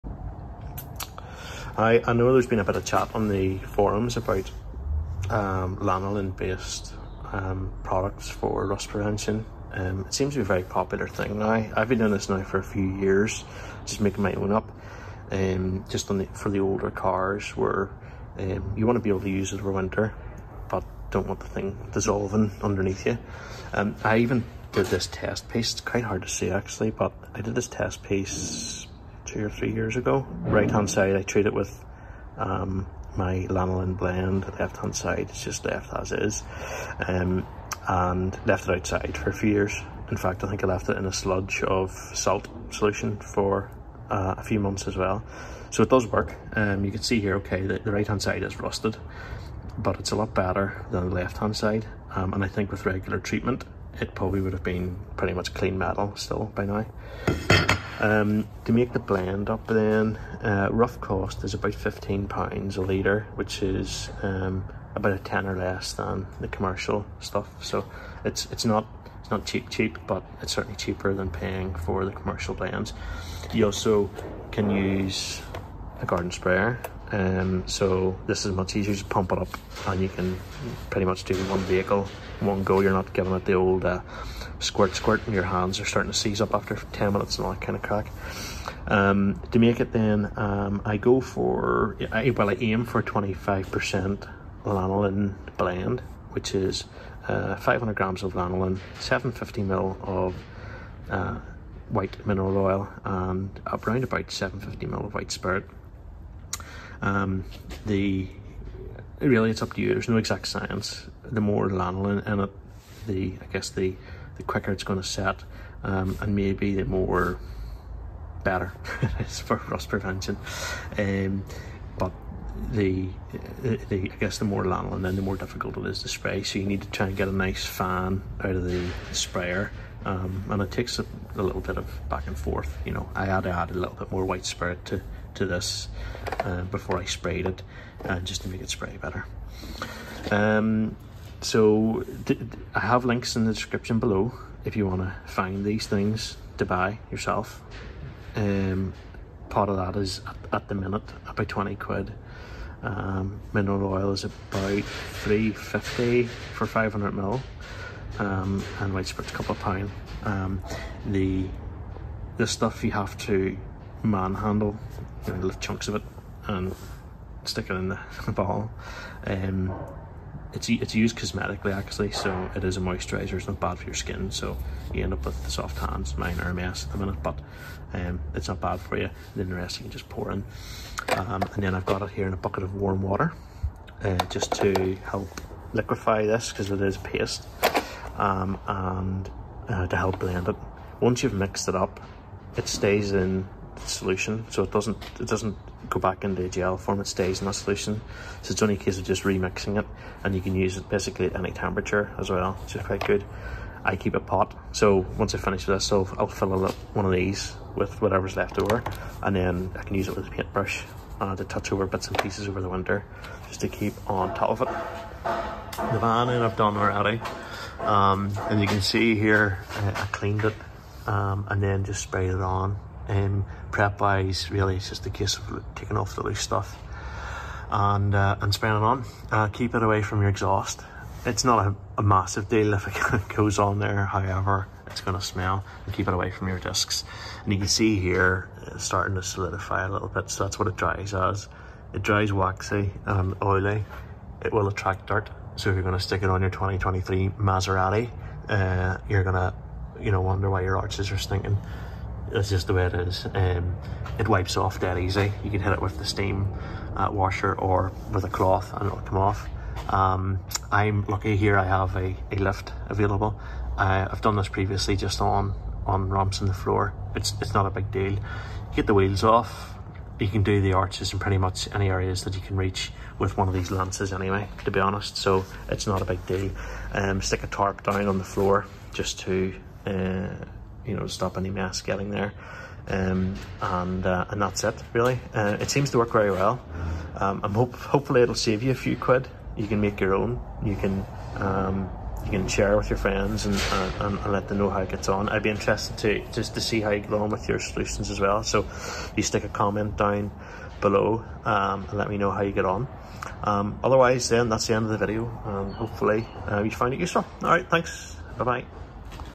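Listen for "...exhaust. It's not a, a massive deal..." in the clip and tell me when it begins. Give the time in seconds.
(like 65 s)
230 s.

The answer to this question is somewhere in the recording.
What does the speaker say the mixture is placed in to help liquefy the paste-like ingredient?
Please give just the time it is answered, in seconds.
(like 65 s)
182 s.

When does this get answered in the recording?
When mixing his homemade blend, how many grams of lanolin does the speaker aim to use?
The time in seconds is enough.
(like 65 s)
97 s.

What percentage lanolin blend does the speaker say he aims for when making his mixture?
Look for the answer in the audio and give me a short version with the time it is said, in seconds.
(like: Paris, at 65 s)
25%, at 93 s.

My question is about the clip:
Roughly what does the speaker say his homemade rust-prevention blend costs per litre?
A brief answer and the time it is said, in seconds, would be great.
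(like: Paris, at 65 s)
15 pounds, at 61 s.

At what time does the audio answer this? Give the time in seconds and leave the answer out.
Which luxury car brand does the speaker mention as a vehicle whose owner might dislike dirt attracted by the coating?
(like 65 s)
247 s.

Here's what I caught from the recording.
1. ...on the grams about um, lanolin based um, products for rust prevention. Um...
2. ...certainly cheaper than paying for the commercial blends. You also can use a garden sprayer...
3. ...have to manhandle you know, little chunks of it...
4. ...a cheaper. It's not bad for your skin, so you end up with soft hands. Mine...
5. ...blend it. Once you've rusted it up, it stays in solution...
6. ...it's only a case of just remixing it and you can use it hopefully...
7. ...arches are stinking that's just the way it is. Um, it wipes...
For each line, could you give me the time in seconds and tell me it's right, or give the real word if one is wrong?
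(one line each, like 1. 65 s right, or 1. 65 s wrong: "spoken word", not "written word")
1. 3 s wrong: "forums", not "grams"
2. 70 s right
3. 162 s right
4. 172 s wrong: "moisturizer", not "cheaper"
5. 190 s wrong: "mixed", not "rusted"
6. 198 s wrong: "basically", not "hopefully"
7. 250 s right.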